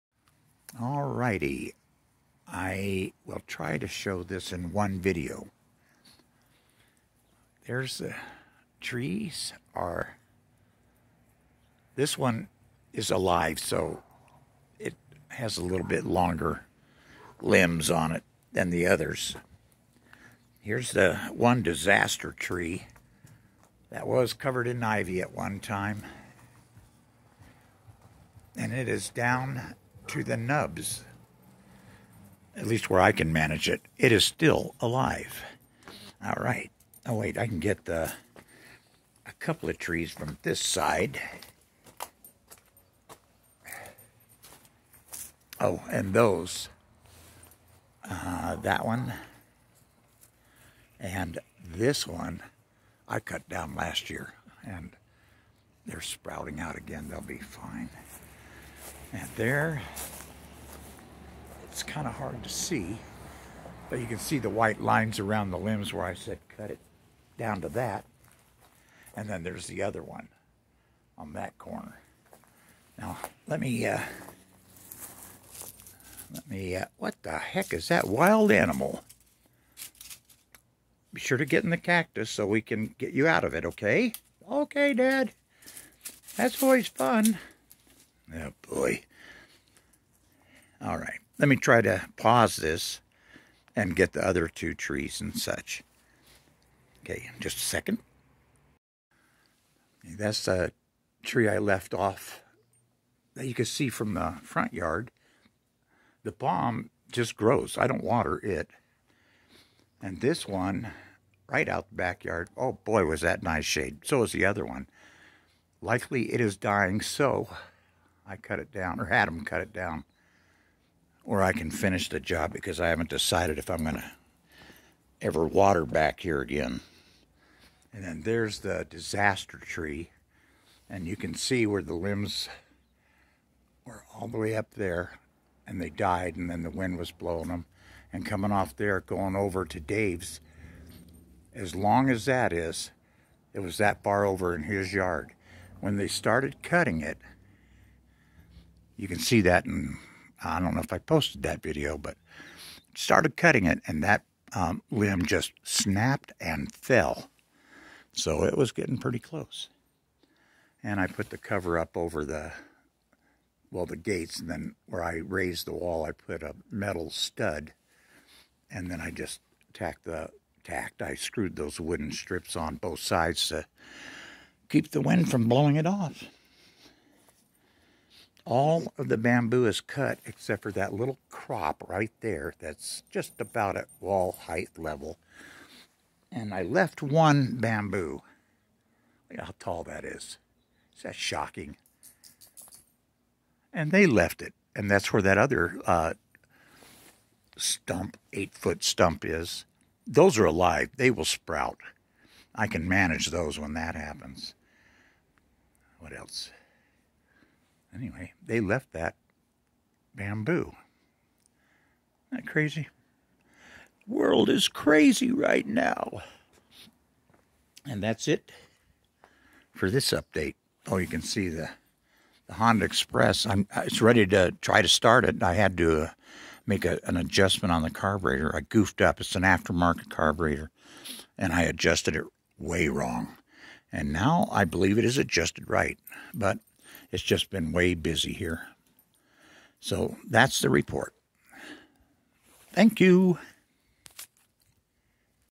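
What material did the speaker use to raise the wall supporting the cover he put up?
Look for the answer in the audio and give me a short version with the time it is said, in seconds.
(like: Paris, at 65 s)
Metal stud, at 166 s.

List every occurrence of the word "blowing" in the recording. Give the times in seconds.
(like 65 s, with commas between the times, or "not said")
137 s, 175 s.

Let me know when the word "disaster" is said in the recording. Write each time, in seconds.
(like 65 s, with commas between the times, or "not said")
21 s, 128 s.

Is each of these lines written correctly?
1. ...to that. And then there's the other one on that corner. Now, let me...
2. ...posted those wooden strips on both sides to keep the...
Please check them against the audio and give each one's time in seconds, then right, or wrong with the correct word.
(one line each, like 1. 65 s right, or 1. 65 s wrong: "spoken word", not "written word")
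1. 67 s right
2. 171 s wrong: "screwed", not "posted".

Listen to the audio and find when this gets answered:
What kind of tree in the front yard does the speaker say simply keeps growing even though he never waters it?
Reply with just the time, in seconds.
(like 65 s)
106 s.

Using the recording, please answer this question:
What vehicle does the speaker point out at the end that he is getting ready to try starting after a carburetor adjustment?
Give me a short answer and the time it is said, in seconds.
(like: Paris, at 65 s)
Honda Express, at 222 s.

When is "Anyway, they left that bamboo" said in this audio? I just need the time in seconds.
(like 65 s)
207 s.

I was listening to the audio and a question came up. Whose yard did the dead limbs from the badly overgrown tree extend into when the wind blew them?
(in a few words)
Dave's.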